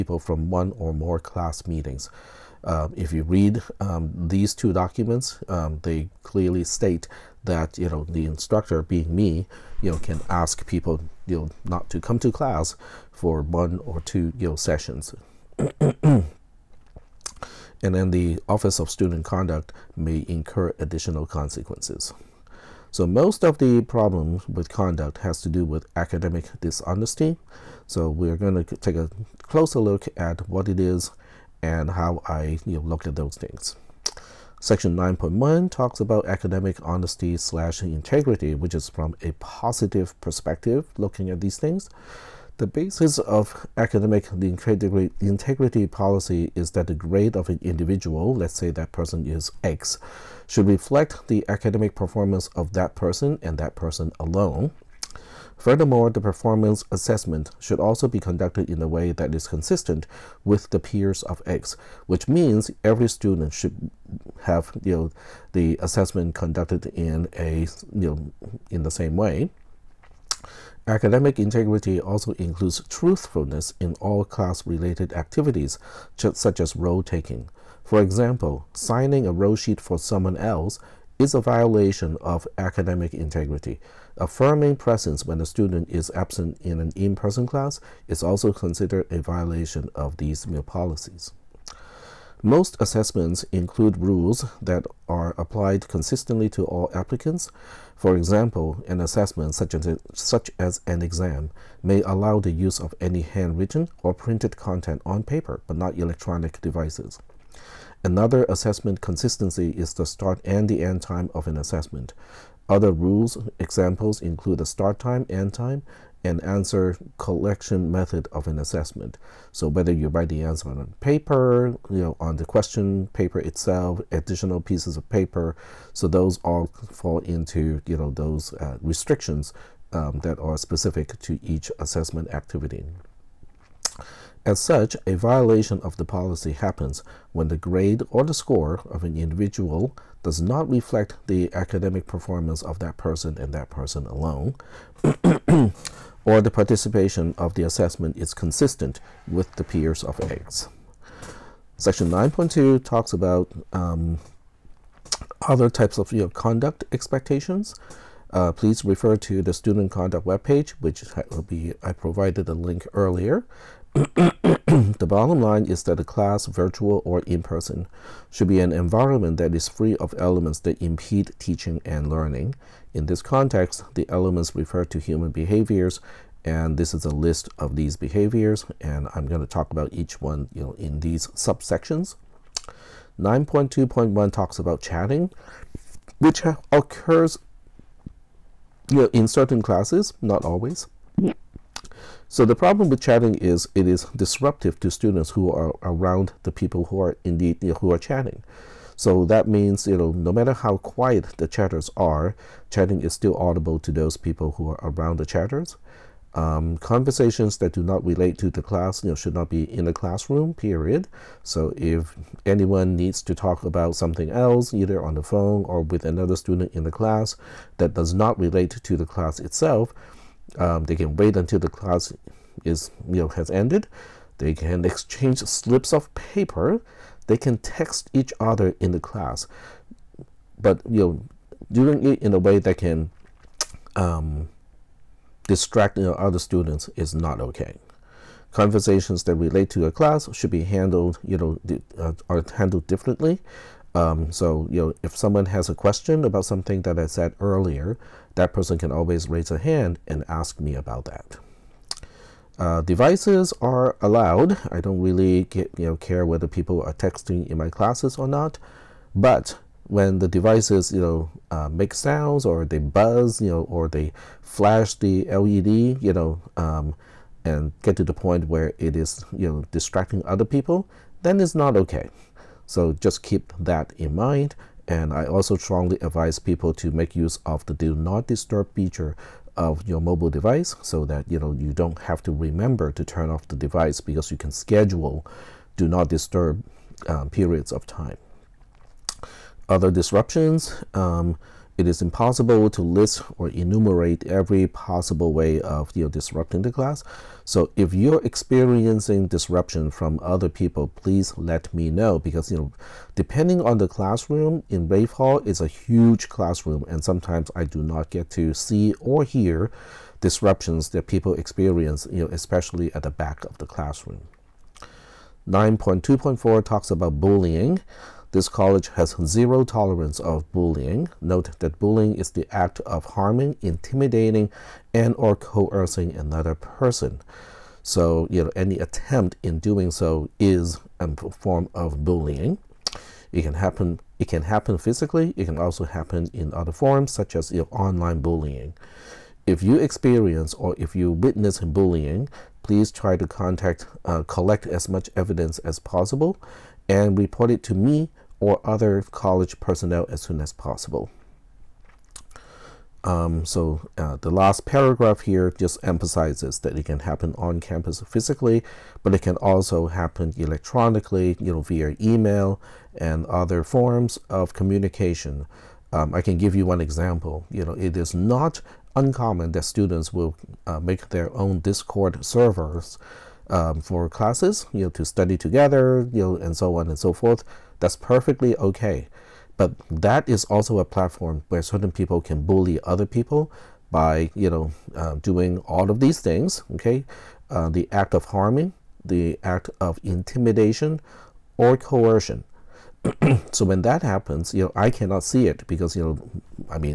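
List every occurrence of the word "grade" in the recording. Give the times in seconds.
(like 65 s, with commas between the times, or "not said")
46 s, 137 s.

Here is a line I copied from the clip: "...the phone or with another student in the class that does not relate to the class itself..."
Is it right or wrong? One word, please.
right.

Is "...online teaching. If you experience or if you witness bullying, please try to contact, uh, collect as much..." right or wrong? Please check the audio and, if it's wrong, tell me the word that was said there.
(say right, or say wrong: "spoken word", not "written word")
wrong: "bullying", not "teaching".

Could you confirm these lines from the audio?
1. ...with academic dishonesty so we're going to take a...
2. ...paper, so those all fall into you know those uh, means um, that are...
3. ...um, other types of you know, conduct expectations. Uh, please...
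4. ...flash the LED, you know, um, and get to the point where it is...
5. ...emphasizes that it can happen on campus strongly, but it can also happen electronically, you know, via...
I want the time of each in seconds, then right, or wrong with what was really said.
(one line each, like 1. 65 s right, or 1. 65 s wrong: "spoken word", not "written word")
1. 25 s right
2. 125 s wrong: "restrictions", not "means"
3. 153 s right
4. 264 s right
5. 355 s wrong: "physically", not "strongly".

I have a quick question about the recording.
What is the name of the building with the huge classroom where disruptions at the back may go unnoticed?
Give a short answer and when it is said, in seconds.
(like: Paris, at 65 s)
Raef Hall, at 304 s.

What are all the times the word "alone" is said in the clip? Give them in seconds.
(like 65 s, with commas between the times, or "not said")
54 s, 144 s.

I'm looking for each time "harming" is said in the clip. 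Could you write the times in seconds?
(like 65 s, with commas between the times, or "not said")
323 s, 388 s.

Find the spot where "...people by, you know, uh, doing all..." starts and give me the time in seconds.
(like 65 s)
383 s.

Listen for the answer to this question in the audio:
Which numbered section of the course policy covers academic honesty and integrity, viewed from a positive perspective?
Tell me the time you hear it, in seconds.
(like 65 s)
34 s.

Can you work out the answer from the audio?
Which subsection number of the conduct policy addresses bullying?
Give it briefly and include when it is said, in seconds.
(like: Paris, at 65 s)
9.2.4, at 315 s.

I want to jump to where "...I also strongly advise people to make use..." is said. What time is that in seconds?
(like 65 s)
275 s.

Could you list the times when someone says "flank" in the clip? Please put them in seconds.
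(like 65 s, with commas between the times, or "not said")
not said.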